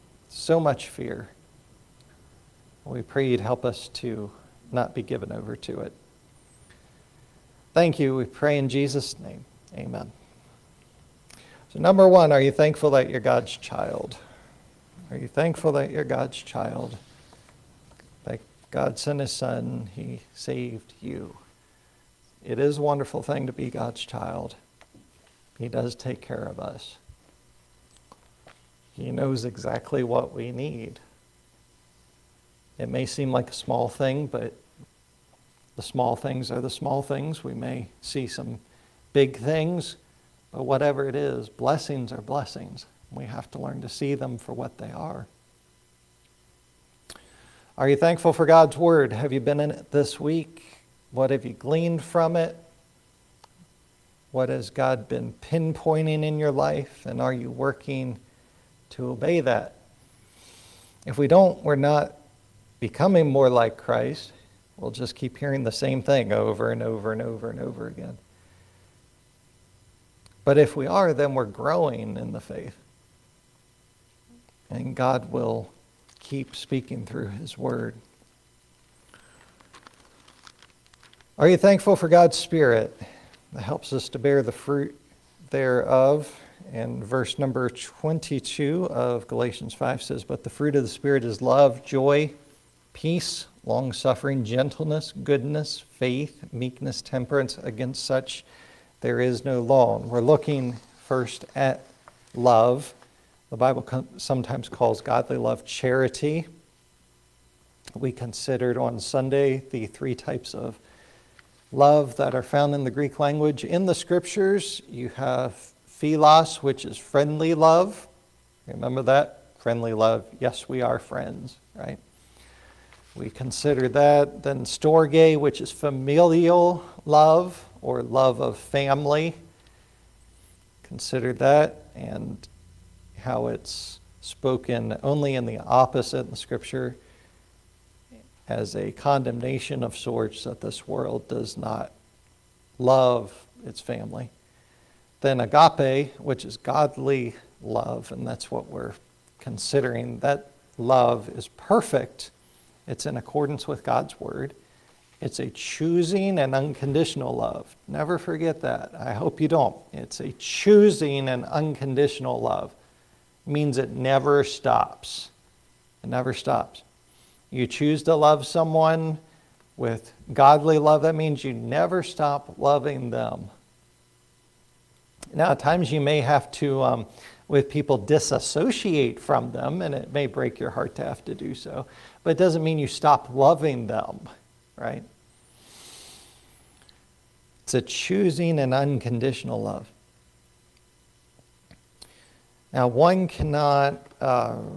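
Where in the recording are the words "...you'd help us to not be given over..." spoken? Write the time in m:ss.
0:03.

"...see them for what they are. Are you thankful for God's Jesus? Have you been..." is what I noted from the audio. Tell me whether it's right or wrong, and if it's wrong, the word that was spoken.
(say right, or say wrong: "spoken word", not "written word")
wrong: "Word", not "Jesus".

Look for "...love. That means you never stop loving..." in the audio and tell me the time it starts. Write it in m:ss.
2:50.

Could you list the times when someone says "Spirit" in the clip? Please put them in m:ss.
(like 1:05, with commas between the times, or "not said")
1:22, 1:30.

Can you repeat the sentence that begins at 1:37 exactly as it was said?
Against such there is no law.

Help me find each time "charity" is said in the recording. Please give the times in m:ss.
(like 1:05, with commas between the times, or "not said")
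1:45.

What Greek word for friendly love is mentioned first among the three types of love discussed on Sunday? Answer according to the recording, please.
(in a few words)
Philos.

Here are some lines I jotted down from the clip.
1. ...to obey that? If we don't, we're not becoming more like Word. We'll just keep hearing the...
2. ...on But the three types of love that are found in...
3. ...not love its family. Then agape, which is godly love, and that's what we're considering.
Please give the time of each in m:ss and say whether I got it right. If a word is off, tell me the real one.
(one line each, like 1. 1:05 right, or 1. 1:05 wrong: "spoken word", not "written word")
1. 0:58 wrong: "Christ", not "Word"
2. 1:48 wrong: "Sunday", not "But"
3. 2:21 right.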